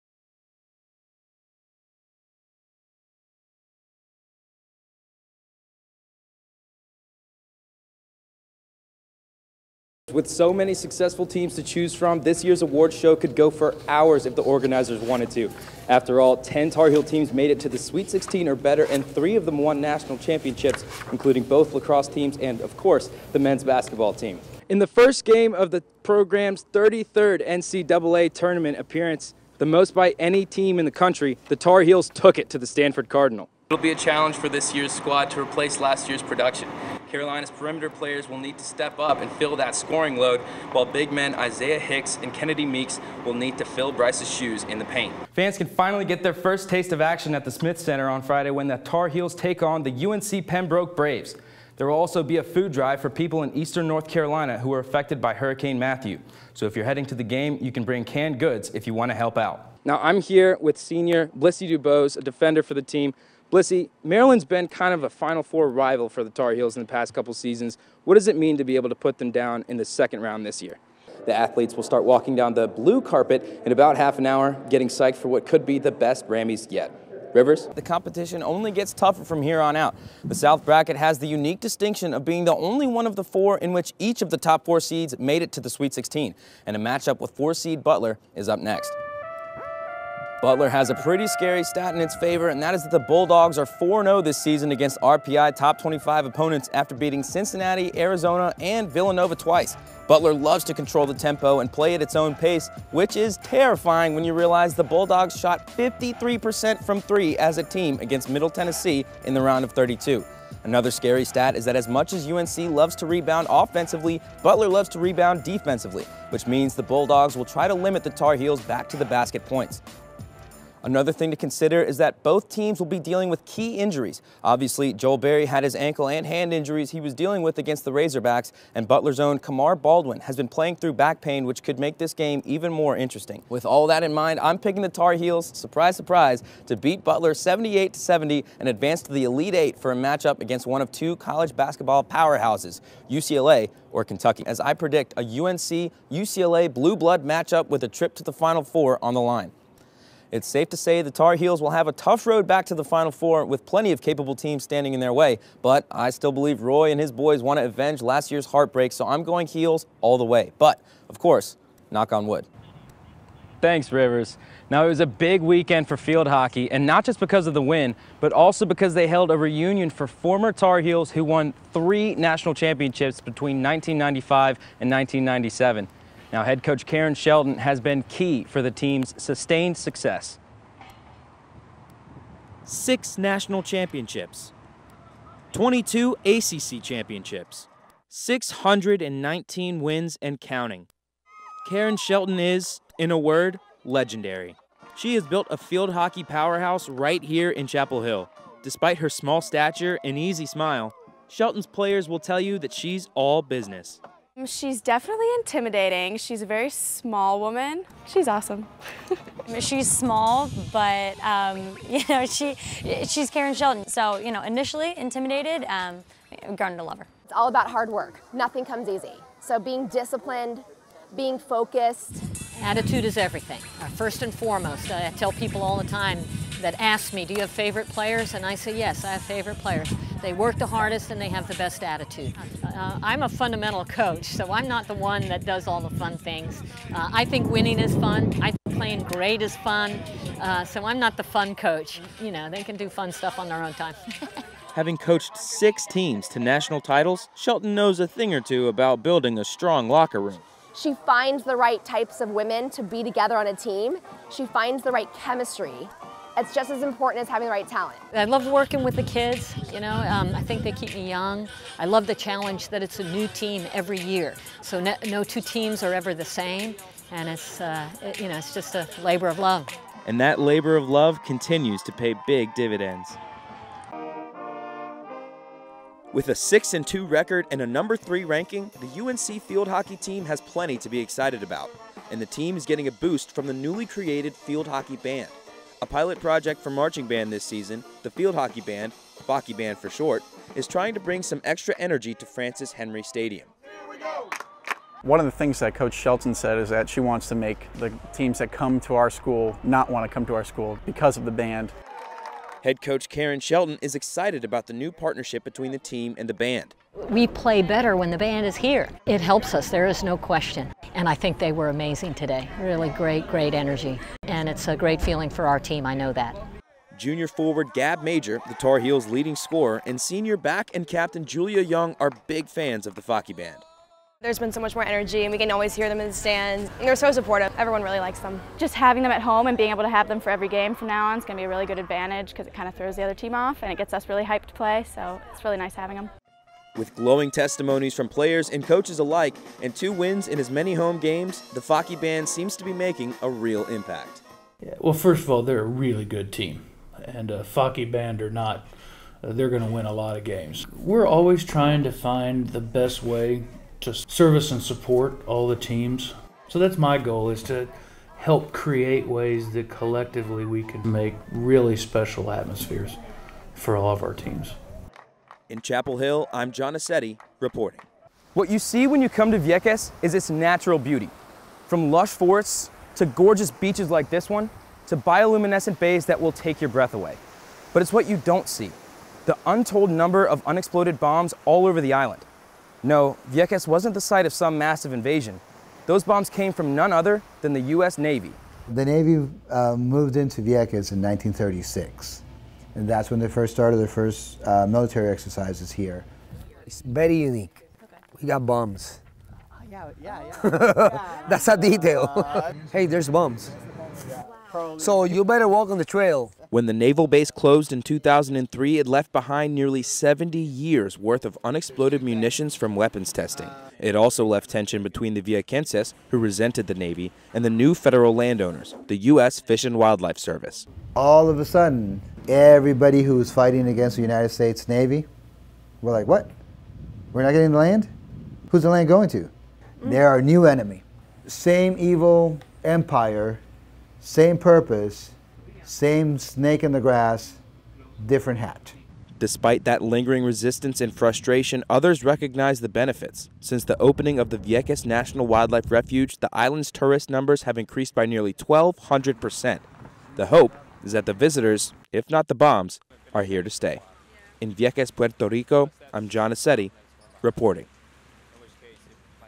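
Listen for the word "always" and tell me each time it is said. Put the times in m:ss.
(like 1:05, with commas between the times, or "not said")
5:25, 5:51.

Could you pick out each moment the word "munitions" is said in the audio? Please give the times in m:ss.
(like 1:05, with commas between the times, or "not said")
6:52.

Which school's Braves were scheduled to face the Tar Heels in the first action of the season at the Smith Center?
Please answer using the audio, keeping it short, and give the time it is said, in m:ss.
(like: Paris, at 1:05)
UNC Pembroke, at 0:50.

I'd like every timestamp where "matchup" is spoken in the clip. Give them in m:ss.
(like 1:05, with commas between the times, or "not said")
1:26, 2:19, 2:27.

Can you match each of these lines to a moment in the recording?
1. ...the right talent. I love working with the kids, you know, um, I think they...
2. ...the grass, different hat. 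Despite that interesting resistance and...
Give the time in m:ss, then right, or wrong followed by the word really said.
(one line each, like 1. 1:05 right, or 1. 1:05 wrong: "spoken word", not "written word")
1. 4:17 right
2. 7:16 wrong: "lingering", not "interesting".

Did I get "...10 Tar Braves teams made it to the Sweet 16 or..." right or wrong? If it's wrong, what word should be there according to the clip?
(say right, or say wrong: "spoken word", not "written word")
wrong: "Heel", not "Braves".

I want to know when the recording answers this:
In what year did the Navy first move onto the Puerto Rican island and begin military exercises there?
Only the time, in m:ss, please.
6:31.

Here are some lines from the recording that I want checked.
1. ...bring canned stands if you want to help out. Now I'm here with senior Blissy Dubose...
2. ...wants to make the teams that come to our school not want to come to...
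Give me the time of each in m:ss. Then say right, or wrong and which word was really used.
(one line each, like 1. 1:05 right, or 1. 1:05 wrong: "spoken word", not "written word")
1. 0:57 wrong: "goods", not "stands"
2. 4:56 right.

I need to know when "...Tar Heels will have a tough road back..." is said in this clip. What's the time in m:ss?
2:31.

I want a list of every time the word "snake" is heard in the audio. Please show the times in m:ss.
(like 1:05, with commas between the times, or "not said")
7:16.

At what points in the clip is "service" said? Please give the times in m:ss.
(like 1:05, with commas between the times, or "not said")
5:53, 7:00.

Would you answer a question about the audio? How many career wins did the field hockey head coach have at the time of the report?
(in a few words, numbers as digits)
619.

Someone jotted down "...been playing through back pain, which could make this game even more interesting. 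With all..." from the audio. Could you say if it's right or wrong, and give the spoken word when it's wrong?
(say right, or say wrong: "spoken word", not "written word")
right.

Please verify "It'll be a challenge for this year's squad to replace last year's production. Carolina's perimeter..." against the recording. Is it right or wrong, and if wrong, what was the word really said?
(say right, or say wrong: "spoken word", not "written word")
right.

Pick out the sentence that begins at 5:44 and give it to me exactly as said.
Yeah, well, first of all, they're a really good team.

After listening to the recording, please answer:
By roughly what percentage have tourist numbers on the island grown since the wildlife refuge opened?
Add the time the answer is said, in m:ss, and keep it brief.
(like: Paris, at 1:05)
1,200%, at 7:28.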